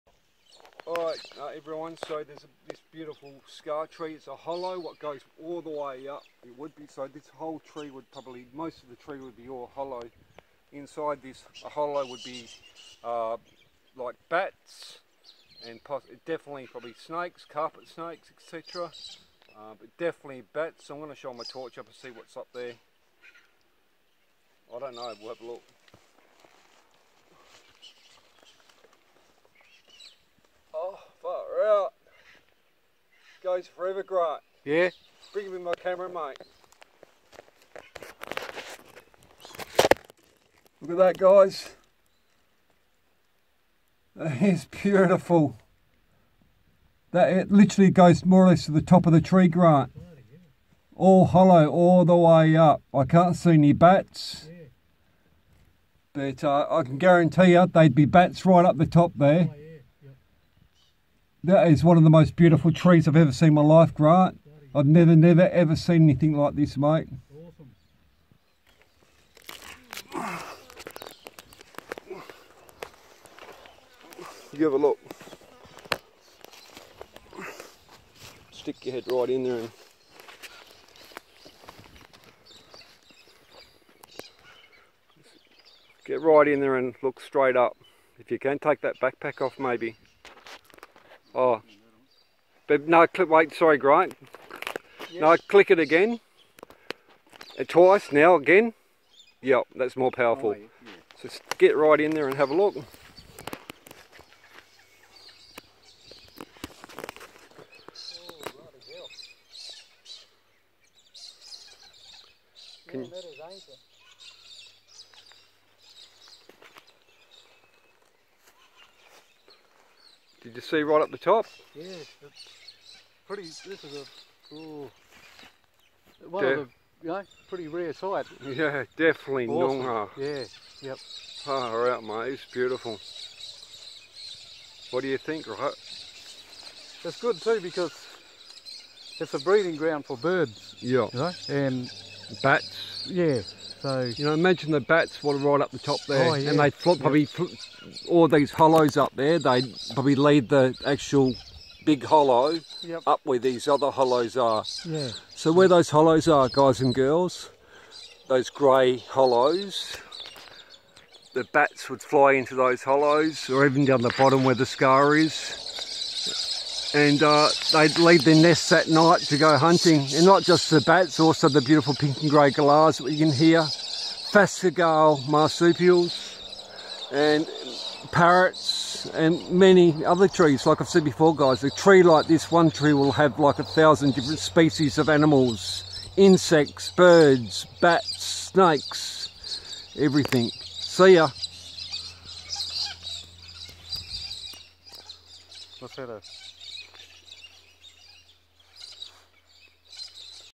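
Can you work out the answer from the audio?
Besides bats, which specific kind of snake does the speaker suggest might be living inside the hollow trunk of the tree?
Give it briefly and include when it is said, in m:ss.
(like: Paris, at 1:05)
Carpet snakes, at 0:17.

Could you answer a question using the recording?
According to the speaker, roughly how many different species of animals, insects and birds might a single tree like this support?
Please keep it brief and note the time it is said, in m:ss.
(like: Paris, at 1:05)
1000, at 3:03.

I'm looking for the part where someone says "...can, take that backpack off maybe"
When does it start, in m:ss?
1:28.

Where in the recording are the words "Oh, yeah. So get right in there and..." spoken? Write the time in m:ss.
1:40.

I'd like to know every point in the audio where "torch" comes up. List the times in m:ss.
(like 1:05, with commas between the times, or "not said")
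0:21.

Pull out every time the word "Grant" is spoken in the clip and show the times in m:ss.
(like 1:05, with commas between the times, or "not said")
0:49, 1:03, 1:33.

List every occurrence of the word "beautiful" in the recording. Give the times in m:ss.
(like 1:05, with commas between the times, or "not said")
0:02, 0:44, 1:02, 2:12, 2:51.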